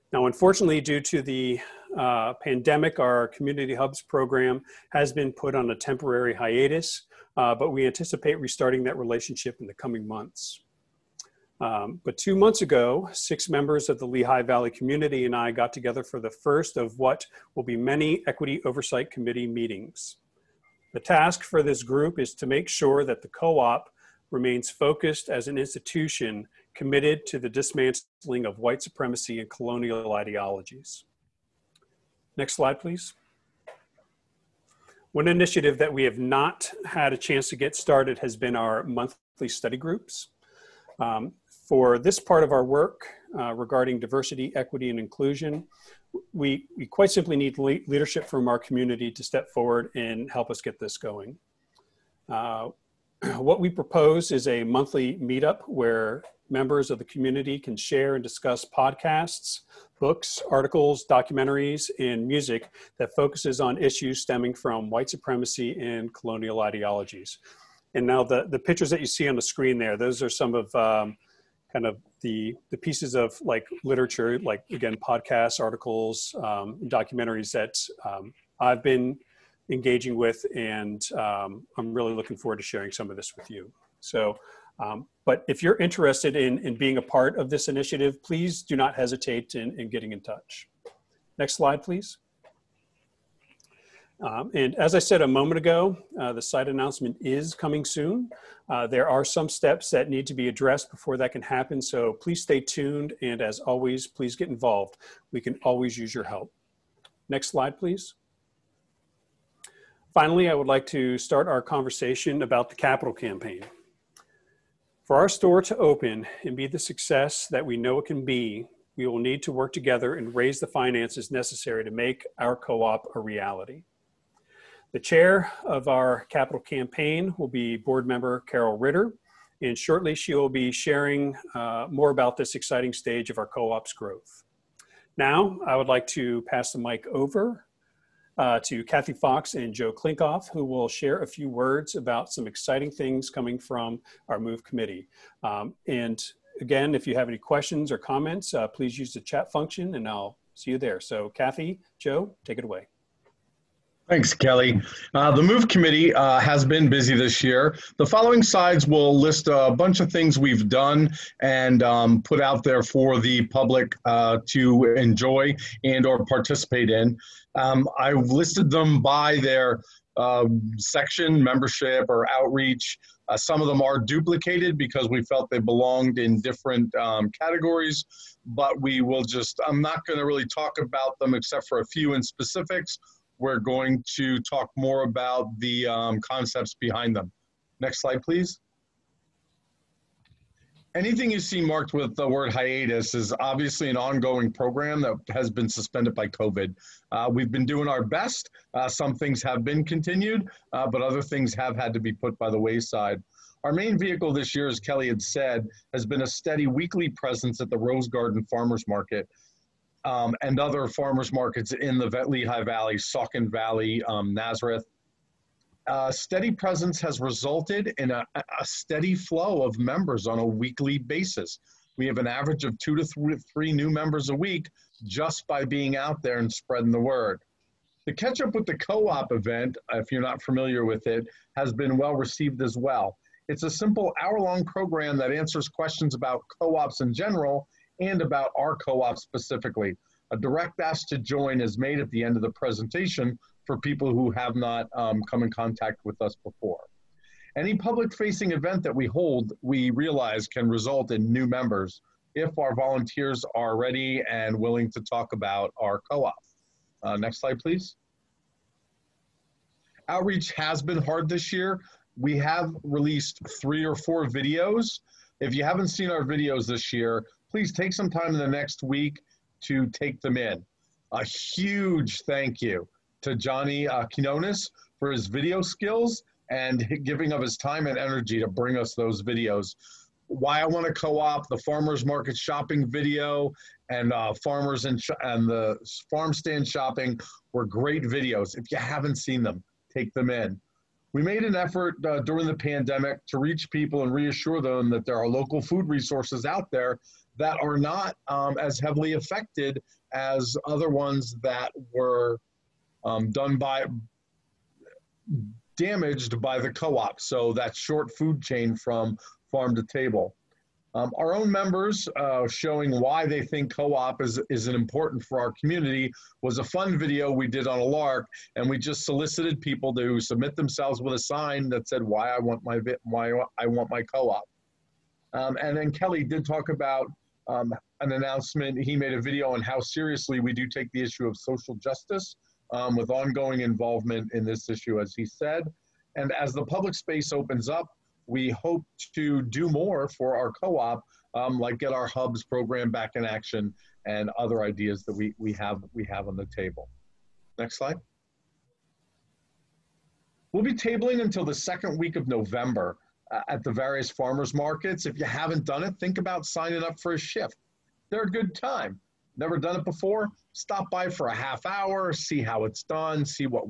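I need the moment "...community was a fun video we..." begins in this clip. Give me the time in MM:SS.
05:15.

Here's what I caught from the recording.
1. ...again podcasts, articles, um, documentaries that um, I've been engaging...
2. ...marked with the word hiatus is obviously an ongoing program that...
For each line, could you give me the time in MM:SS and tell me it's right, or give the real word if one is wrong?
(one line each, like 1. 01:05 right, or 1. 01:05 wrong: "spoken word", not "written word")
1. 01:14 right
2. 03:11 right.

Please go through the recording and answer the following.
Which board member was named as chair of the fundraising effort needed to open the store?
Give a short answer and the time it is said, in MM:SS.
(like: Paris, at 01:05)
Carol Ritter, at 02:08.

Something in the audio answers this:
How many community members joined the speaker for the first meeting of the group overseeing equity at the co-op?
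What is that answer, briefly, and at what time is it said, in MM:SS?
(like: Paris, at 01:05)
6, at 00:13.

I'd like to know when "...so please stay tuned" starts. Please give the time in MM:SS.
01:41.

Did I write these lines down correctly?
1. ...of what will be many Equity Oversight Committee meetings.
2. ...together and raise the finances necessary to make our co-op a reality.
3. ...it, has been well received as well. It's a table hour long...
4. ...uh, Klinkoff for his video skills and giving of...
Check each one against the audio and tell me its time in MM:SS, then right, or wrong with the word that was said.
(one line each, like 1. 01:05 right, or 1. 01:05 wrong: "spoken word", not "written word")
1. 00:16 right
2. 01:59 right
3. 03:51 wrong: "simple", not "table"
4. 04:33 wrong: "Quinones", not "Klinkoff".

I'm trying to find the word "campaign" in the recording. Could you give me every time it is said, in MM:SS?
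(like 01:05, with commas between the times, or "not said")
01:53, 02:06.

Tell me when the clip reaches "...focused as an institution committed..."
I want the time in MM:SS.
00:24.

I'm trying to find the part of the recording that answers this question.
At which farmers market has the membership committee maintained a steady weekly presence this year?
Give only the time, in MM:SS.
03:27.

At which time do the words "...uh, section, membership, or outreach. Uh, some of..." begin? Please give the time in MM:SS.
02:50.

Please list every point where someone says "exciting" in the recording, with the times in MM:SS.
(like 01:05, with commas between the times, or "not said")
02:12, 02:22.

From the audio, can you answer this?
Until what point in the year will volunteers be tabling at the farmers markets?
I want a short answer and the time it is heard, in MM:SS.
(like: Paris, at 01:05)
Second week of November, at 05:51.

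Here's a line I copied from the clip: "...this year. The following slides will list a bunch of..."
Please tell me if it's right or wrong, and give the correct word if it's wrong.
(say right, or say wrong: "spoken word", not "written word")
right.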